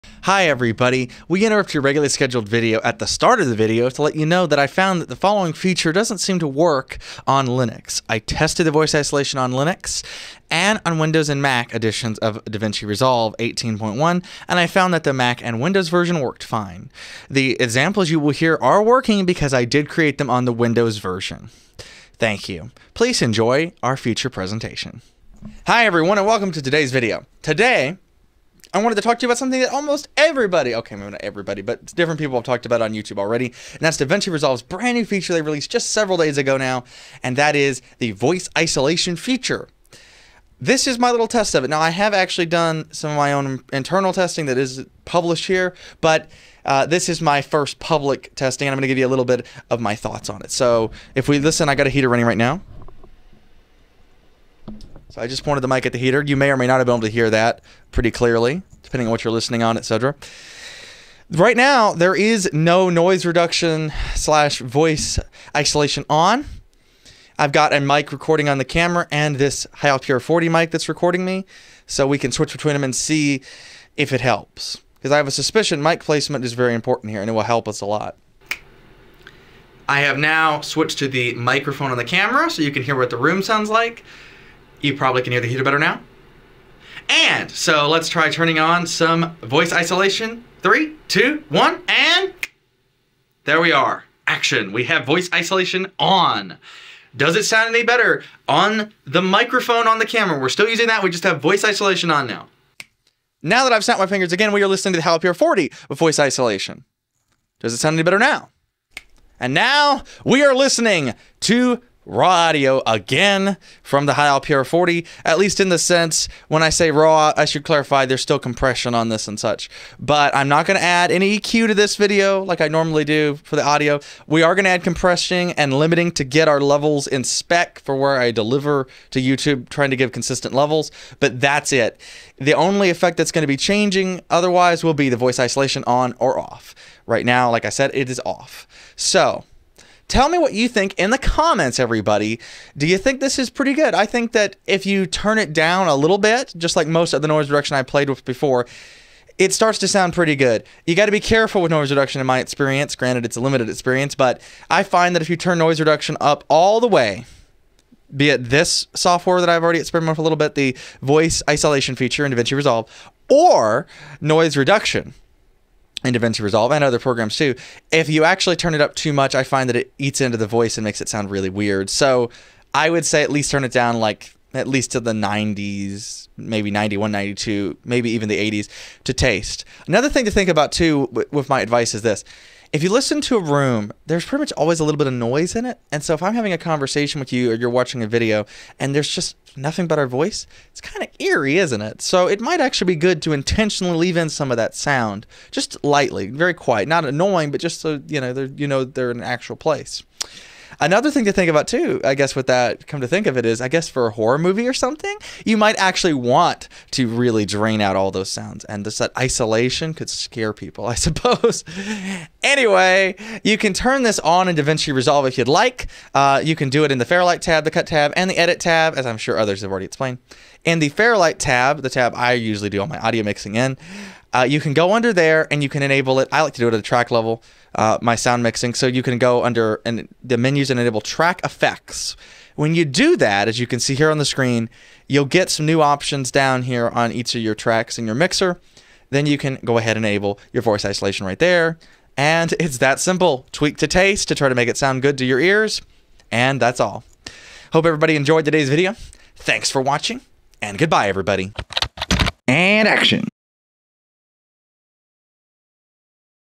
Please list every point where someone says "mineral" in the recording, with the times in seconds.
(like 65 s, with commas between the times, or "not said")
not said.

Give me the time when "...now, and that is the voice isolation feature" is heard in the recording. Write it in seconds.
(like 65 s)
36 s.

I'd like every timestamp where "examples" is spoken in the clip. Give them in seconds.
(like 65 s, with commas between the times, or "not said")
17 s.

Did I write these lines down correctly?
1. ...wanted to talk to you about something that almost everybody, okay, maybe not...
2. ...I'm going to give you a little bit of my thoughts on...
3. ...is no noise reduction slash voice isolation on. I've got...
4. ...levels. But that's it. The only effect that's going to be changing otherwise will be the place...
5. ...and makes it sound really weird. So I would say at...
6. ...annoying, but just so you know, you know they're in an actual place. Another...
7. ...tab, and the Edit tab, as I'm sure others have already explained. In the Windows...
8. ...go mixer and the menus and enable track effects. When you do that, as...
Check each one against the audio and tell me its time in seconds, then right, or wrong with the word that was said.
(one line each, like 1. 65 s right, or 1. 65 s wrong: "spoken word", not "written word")
1. 28 s right
2. 48 s right
3. 62 s right
4. 130 s wrong: "voice", not "place"
5. 170 s right
6. 197 s right
7. 217 s wrong: "Fairlight", not "Windows"
8. 229 s wrong: "under", not "mixer".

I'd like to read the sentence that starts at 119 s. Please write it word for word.
But I'm not going to add any EQ to this video like I normally do for the audio.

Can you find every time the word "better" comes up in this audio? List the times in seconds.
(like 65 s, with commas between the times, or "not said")
85 s, 97 s, 108 s.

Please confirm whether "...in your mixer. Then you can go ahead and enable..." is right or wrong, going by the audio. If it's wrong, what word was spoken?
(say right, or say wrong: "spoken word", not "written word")
right.